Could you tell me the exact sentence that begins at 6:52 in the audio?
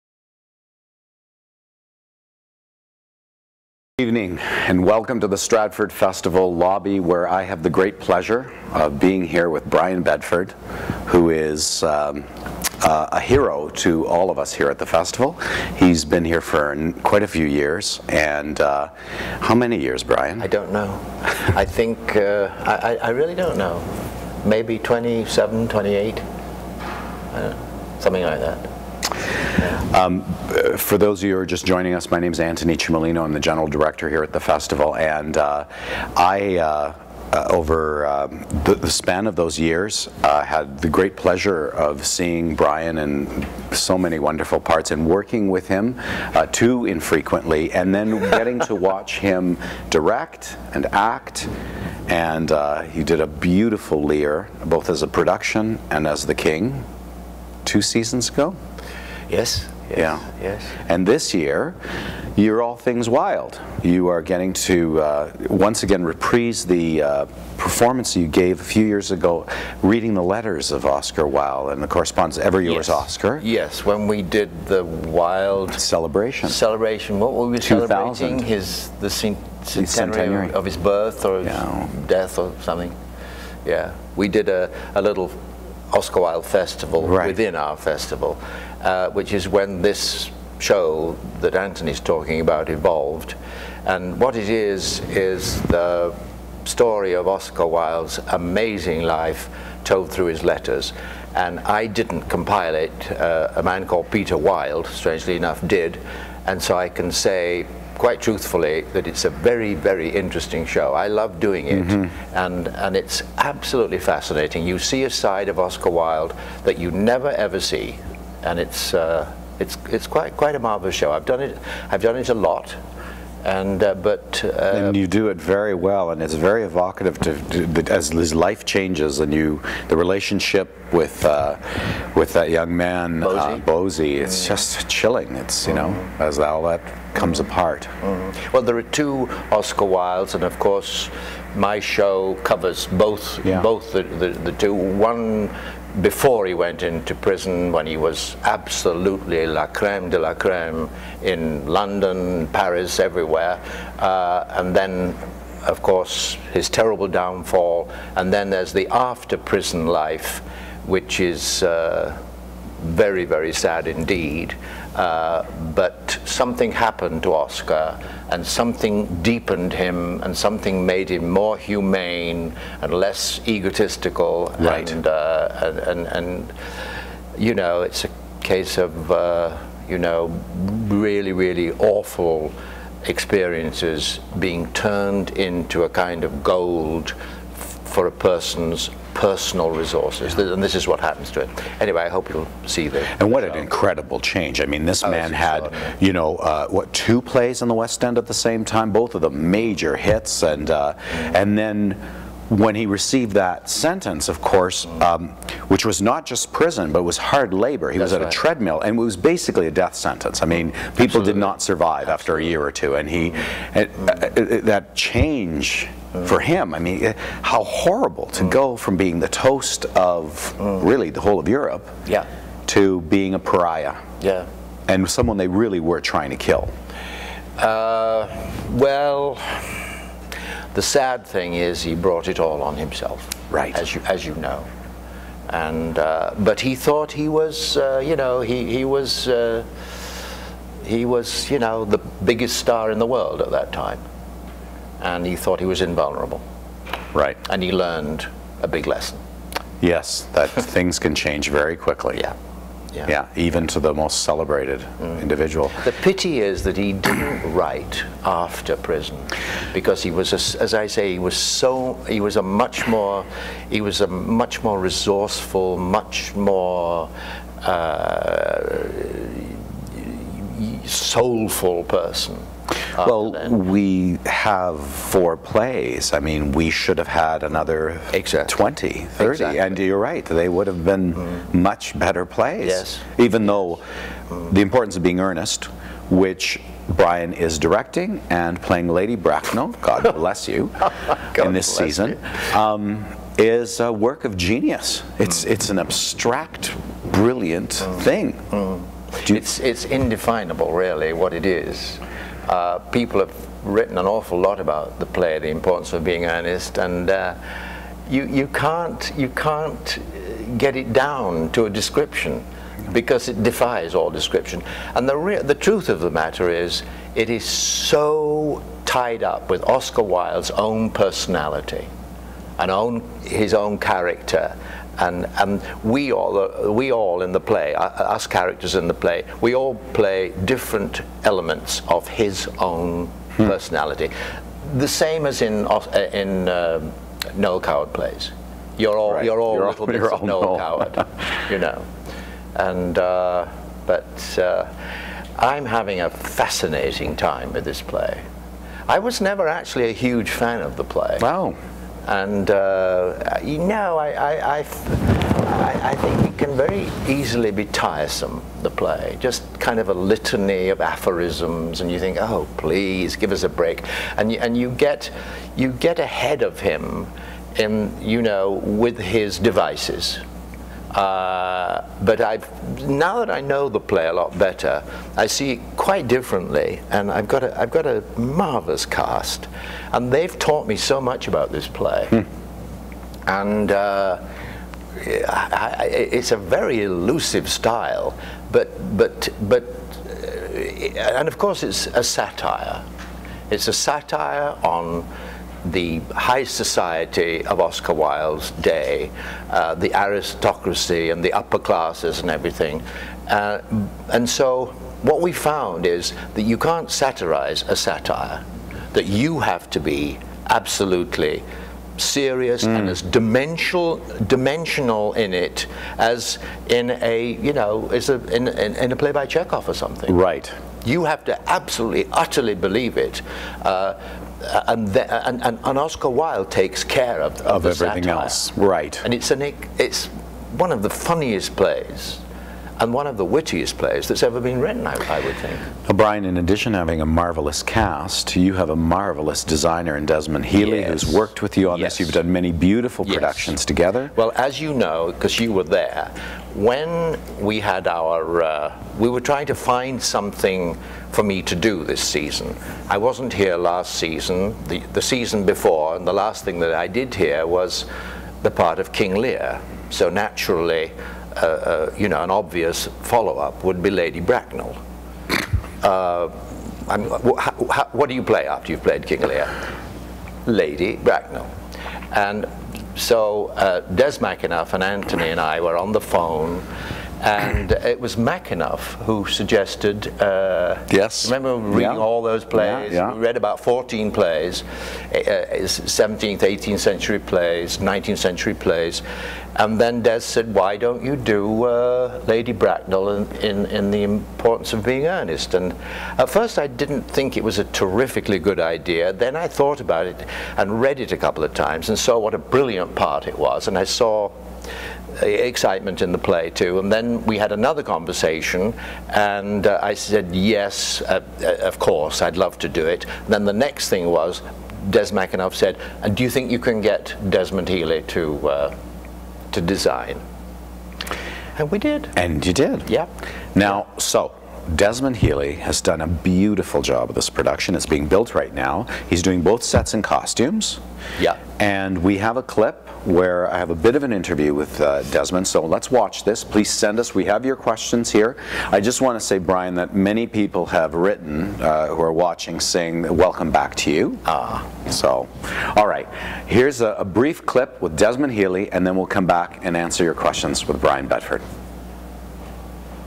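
as dimensional dimensional in it as in a you know a, in, in, in a play by Chekhov or something.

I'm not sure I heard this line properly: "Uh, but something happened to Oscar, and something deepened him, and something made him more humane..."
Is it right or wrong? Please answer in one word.
right.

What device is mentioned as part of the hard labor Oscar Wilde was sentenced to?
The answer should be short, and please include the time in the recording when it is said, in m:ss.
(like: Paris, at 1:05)
a treadmill, at 3:28.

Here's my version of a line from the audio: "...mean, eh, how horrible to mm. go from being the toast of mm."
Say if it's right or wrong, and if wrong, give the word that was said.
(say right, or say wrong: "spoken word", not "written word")
right.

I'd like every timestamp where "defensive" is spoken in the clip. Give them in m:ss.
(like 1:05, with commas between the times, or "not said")
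not said.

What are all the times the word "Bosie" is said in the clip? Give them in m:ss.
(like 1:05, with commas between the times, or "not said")
2:13.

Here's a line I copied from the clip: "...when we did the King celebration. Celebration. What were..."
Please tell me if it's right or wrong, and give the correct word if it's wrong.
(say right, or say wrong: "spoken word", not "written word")
wrong: "Wilde", not "King".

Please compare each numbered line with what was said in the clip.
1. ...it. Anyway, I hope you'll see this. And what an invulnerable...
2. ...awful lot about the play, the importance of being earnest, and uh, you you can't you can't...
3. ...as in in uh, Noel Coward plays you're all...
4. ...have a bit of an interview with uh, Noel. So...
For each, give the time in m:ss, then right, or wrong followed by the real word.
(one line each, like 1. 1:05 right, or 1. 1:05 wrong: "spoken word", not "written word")
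1. 3:11 wrong: "incredible", not "invulnerable"
2. 5:04 right
3. 5:35 right
4. 8:53 wrong: "Desmond", not "Noel".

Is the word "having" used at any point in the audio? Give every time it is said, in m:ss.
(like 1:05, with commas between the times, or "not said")
5:45, 7:16.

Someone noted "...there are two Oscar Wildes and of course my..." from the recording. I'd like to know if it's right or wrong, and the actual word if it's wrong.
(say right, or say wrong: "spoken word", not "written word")
right.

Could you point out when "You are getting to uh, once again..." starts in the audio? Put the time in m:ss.
1:03.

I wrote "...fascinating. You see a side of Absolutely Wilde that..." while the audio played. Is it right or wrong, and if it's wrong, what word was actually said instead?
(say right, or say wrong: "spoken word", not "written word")
wrong: "Oscar", not "Absolutely".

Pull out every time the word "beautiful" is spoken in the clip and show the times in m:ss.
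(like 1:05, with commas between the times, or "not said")
0:53, 7:22, 8:46.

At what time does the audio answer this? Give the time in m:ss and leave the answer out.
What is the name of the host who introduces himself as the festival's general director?
0:32.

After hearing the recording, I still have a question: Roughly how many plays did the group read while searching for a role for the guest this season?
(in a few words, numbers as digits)
14.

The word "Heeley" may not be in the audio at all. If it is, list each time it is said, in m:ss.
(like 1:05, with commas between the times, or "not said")
7:20, 8:37, 8:45, 9:08.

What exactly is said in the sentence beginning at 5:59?
Just kind of a litany of aphorisms, and you think, oh, please, give us a break.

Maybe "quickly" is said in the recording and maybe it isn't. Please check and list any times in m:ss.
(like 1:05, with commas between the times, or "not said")
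4:11.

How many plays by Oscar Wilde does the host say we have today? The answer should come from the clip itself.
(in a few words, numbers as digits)
4.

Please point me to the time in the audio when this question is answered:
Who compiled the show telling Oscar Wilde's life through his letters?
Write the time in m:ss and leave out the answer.
1:44.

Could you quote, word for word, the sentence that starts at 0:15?
He's been here for quite a few years and uh, how many years Brian?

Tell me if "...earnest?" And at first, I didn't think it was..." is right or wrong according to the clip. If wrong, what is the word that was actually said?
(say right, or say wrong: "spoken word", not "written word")
right.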